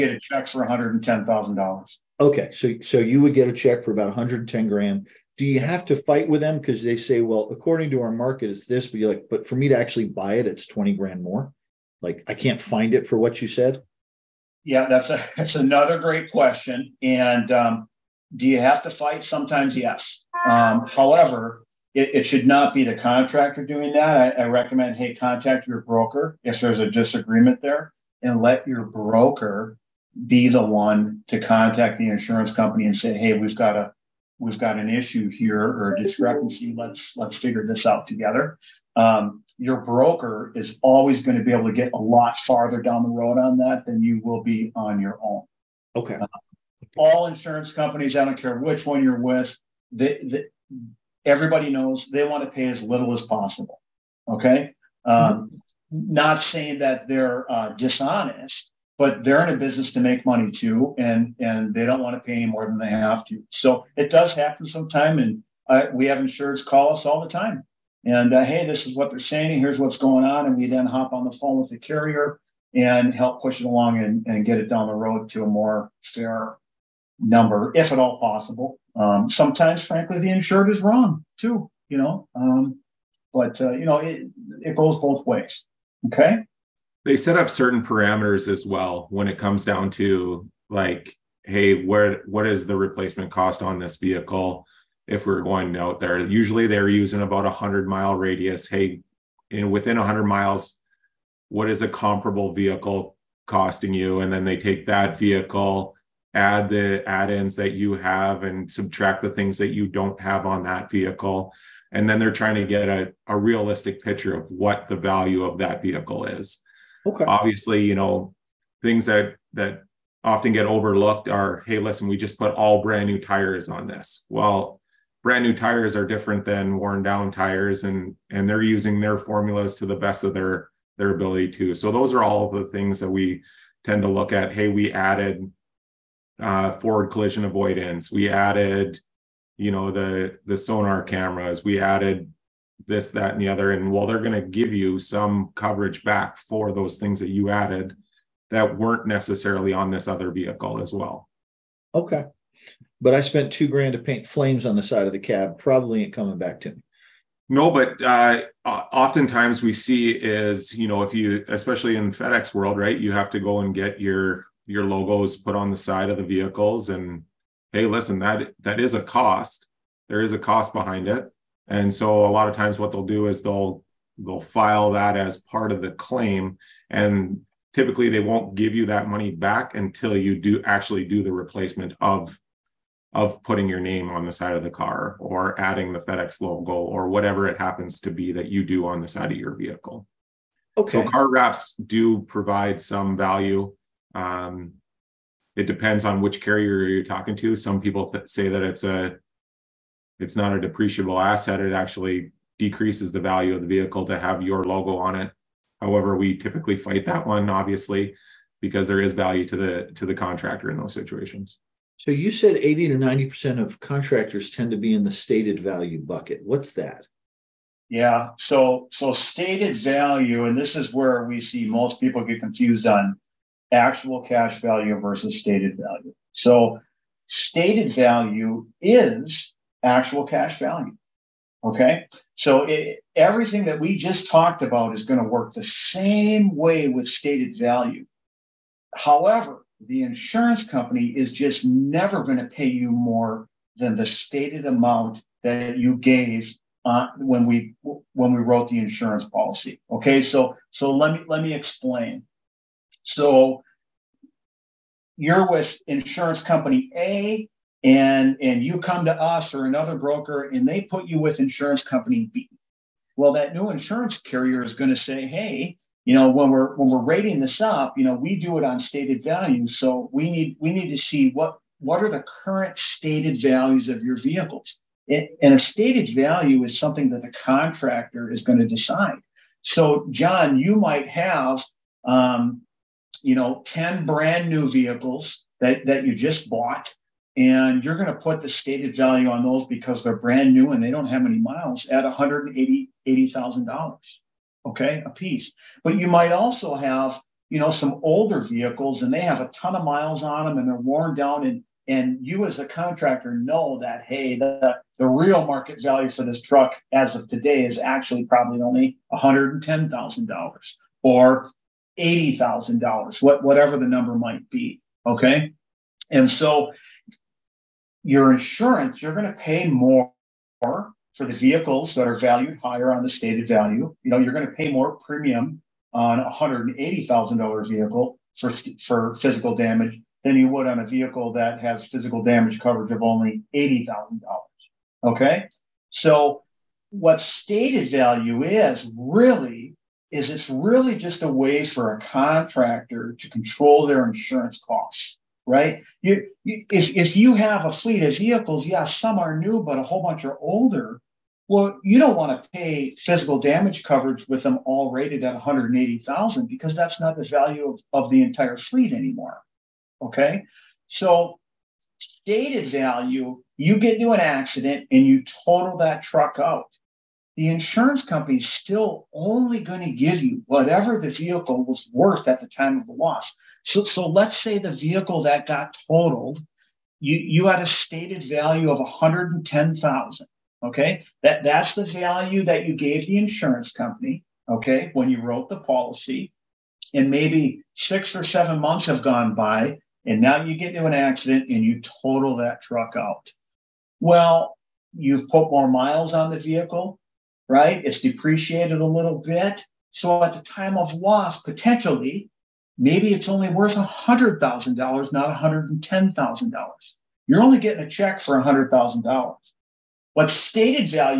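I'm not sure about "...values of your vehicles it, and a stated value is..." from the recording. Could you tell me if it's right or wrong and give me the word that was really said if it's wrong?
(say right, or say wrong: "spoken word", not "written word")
right.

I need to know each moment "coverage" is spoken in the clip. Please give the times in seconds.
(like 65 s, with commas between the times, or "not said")
145 s, 332 s, 353 s.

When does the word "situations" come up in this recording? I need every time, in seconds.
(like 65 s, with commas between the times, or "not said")
210 s.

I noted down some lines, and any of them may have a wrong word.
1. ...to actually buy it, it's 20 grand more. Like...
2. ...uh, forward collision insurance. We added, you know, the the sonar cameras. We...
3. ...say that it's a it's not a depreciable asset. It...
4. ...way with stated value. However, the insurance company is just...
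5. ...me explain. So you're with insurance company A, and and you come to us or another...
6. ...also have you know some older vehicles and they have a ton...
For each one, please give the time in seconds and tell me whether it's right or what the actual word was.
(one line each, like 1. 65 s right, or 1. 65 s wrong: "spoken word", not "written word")
1. 9 s right
2. 136 s wrong: "avoidance", not "insurance"
3. 198 s right
4. 236 s right
5. 251 s right
6. 296 s right.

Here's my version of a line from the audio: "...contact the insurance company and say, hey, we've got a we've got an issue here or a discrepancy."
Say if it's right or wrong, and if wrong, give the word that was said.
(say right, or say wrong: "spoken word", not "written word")
right.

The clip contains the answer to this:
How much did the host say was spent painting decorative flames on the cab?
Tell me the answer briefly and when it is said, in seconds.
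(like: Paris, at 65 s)
$2,000, at 153 s.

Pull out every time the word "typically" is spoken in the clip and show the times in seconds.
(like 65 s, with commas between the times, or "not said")
177 s, 206 s.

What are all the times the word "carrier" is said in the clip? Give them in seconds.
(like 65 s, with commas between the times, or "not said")
71 s, 196 s, 264 s.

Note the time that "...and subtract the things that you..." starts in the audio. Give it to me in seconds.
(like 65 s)
108 s.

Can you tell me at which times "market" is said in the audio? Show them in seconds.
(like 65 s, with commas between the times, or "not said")
8 s, 305 s.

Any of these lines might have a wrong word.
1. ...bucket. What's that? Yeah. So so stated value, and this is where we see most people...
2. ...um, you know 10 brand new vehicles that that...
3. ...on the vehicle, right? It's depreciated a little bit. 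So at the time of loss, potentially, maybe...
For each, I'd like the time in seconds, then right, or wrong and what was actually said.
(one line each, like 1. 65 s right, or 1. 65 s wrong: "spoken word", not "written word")
1. 216 s right
2. 282 s right
3. 396 s right.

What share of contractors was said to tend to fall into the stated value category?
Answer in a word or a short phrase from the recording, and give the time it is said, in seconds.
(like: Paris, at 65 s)
80 to 90%, at 212 s.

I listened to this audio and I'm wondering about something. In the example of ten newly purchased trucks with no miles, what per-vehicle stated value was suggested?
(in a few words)
$180,000.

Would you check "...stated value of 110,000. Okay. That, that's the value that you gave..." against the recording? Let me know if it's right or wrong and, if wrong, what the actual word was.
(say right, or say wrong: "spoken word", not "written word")
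right.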